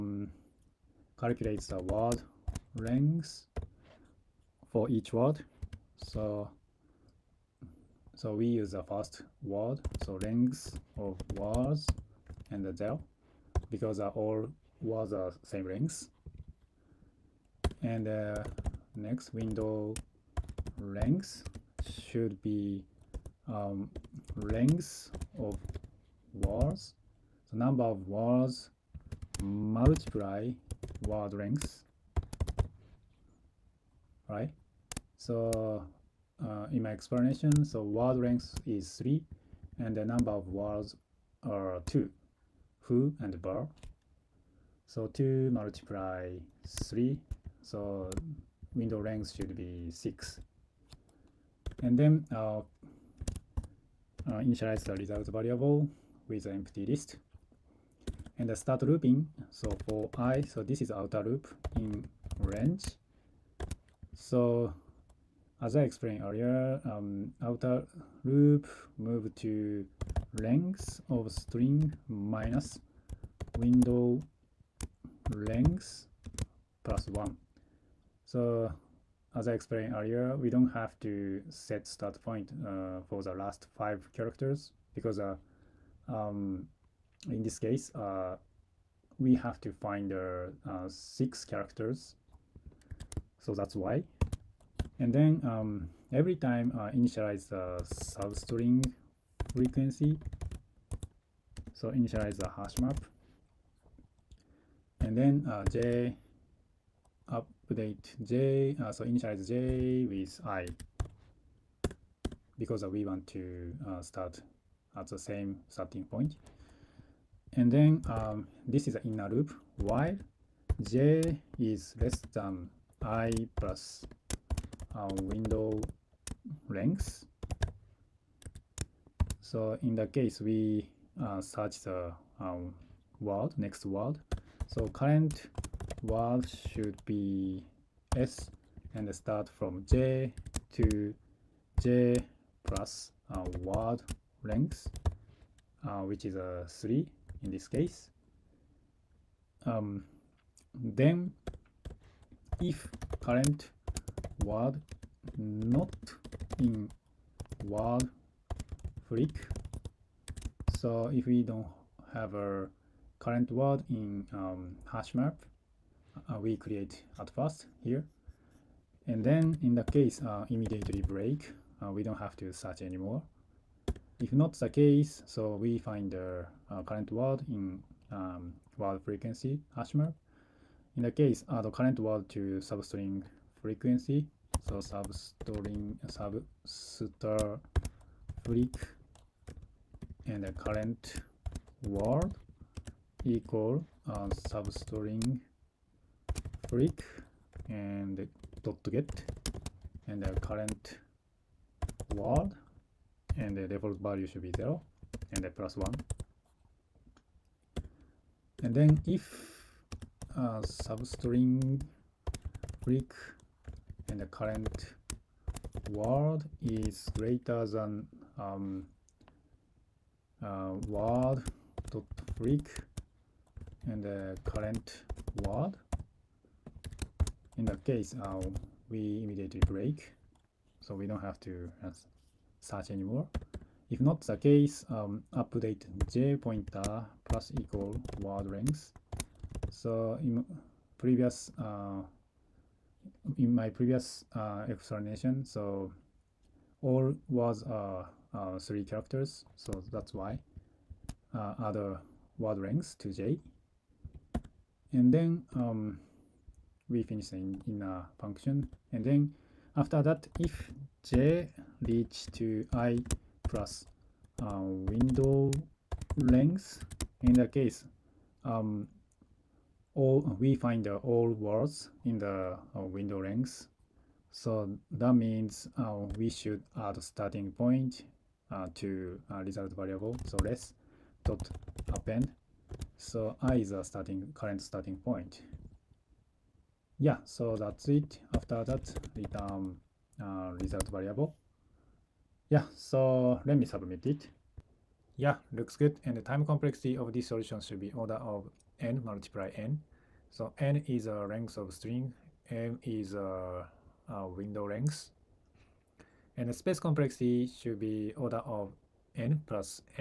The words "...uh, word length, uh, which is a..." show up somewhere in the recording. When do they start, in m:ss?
2:23.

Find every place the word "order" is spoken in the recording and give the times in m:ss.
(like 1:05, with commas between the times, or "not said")
4:57, 5:08.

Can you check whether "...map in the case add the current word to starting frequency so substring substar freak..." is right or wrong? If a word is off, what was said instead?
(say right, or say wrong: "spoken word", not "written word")
wrong: "substring", not "starting".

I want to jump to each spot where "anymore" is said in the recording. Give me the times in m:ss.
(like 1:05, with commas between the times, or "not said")
2:52, 3:52.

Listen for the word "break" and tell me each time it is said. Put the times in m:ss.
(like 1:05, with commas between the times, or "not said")
2:51, 3:16, 3:32, 3:42, 3:49.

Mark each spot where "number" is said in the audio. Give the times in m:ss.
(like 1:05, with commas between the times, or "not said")
0:27, 0:40.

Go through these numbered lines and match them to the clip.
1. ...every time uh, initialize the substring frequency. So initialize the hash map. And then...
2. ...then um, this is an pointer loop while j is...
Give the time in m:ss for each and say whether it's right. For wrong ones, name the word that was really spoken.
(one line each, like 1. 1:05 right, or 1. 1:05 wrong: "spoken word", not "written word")
1. 1:36 right
2. 1:57 wrong: "inner", not "pointer".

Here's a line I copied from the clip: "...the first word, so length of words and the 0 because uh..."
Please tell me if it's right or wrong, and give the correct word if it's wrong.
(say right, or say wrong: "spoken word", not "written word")
right.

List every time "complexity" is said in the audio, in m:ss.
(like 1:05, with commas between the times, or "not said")
4:56, 5:06.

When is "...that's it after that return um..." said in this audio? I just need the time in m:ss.
4:47.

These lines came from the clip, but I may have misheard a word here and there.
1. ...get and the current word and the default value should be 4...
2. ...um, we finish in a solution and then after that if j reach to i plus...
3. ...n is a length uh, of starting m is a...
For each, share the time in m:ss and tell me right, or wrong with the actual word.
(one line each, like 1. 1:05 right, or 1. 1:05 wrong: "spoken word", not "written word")
1. 3:18 wrong: "0", not "4"
2. 4:15 wrong: "function", not "solution"
3. 5:00 wrong: "string", not "starting".